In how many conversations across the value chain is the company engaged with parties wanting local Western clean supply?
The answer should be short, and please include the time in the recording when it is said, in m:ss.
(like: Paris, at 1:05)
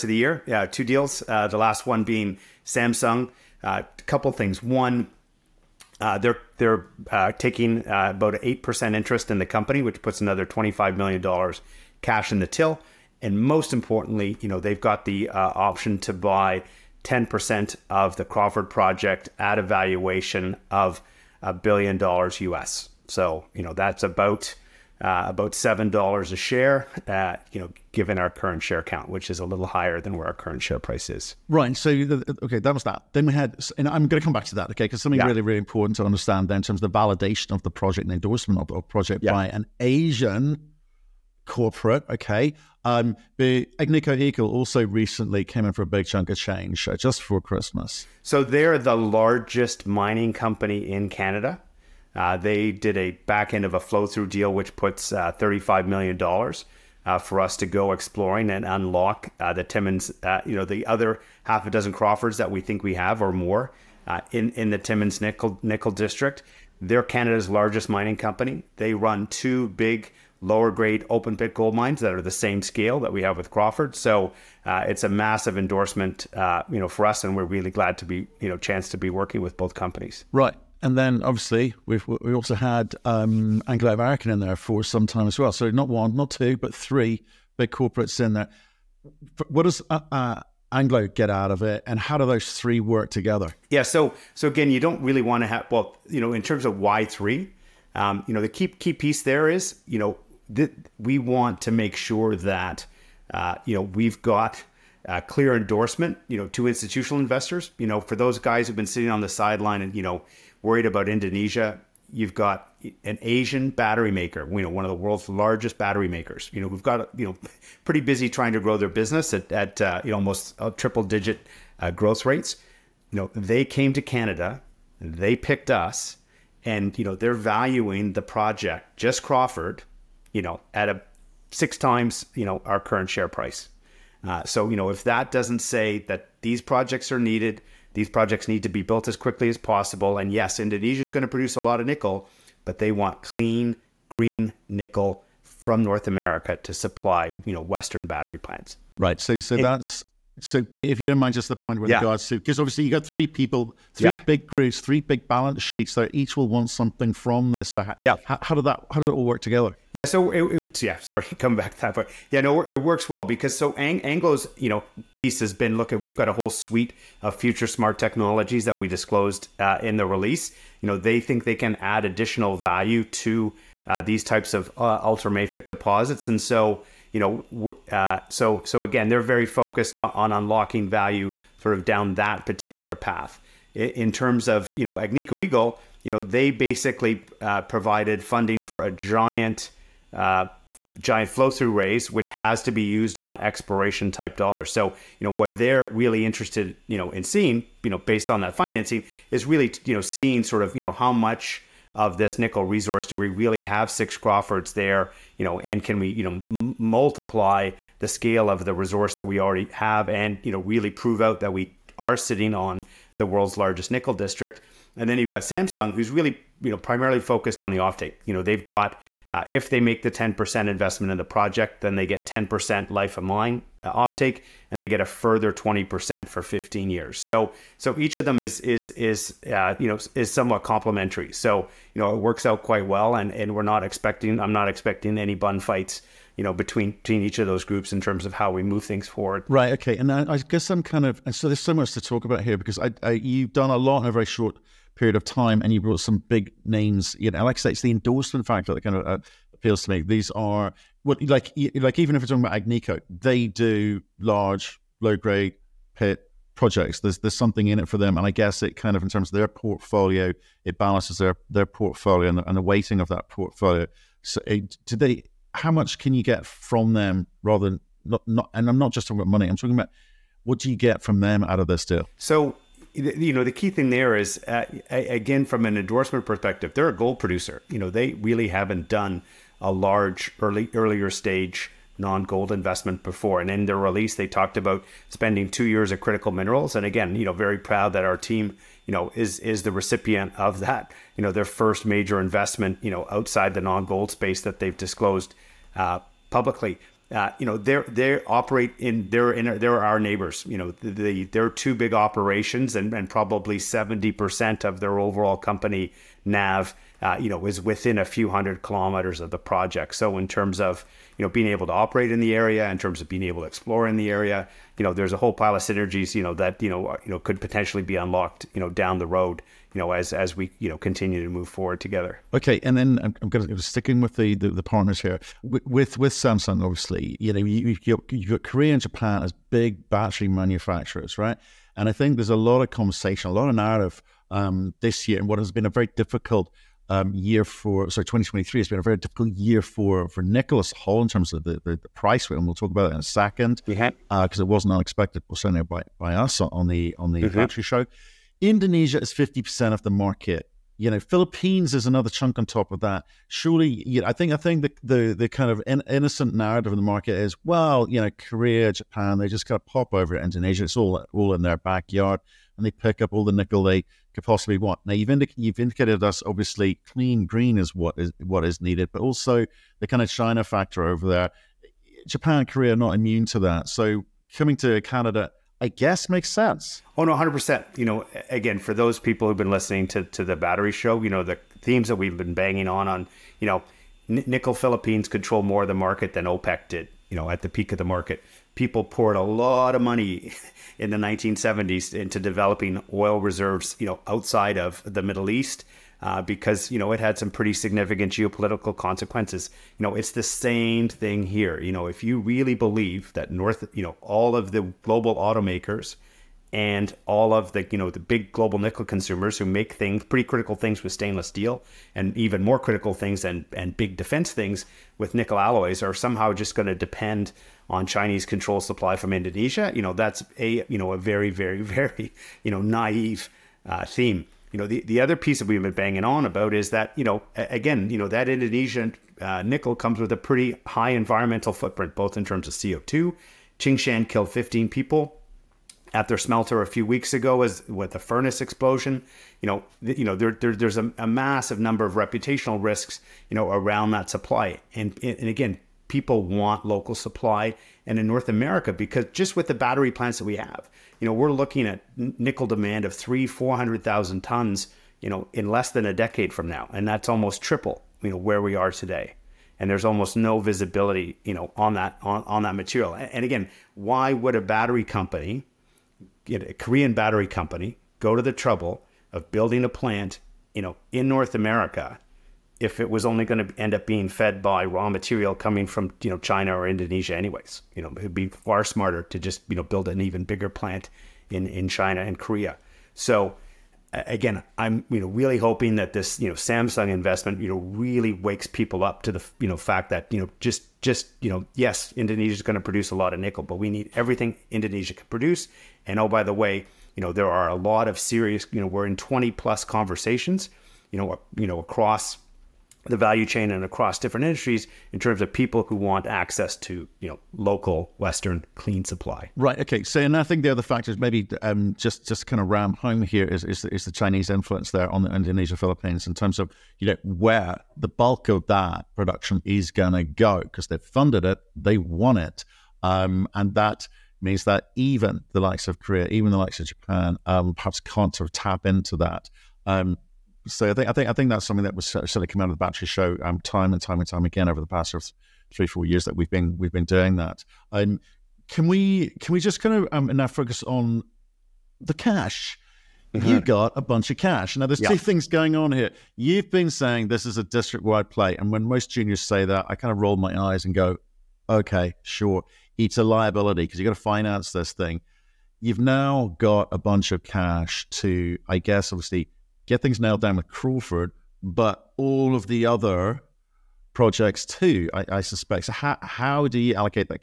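20-plus, at 8:18.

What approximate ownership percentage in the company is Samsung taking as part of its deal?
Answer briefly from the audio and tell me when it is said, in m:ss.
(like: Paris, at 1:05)
8%, at 0:08.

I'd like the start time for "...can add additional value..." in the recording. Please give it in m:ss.
2:51.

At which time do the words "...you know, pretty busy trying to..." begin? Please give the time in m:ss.
1:57.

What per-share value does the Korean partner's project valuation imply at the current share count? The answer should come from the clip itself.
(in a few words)
$7.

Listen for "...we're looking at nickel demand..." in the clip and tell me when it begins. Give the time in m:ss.
7:31.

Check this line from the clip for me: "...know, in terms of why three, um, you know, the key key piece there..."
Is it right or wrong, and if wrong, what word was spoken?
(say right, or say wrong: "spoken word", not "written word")
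right.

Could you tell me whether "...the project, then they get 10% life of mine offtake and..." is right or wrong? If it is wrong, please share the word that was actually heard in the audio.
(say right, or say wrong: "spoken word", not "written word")
right.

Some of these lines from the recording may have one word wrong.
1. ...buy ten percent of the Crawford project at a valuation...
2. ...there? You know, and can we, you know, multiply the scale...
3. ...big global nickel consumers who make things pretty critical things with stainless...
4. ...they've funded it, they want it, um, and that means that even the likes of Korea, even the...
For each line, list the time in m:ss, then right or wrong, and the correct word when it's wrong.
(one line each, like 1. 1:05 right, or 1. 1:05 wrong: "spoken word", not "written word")
1. 0:16 right
2. 3:24 right
3. 6:47 right
4. 8:40 right.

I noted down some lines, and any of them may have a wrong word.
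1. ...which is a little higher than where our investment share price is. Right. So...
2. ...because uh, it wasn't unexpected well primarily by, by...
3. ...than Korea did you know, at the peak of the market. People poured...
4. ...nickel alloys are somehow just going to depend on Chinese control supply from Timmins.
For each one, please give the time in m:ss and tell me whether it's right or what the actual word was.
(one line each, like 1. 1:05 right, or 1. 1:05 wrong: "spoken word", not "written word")
1. 0:29 wrong: "current", not "investment"
2. 5:43 wrong: "certainly", not "primarily"
3. 6:26 wrong: "OPEC", not "Korea"
4. 6:55 wrong: "Indonesia", not "Timmins".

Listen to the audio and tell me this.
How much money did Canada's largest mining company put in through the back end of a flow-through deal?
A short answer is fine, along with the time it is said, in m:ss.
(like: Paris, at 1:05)
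$35 million, at 0:55.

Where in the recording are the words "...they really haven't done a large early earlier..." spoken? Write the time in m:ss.
4:37.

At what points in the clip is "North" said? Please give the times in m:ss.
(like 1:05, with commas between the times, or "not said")
2:25, 6:43, 7:28, 7:51.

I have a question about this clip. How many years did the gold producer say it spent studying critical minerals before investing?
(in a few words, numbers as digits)
2.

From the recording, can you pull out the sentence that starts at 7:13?
Tsingshan killed 15 people at their smelter a few weeks ago as with the furnace explosion.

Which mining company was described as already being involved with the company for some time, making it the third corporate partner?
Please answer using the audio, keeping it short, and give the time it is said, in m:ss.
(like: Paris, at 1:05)
Anglo American, at 1:23.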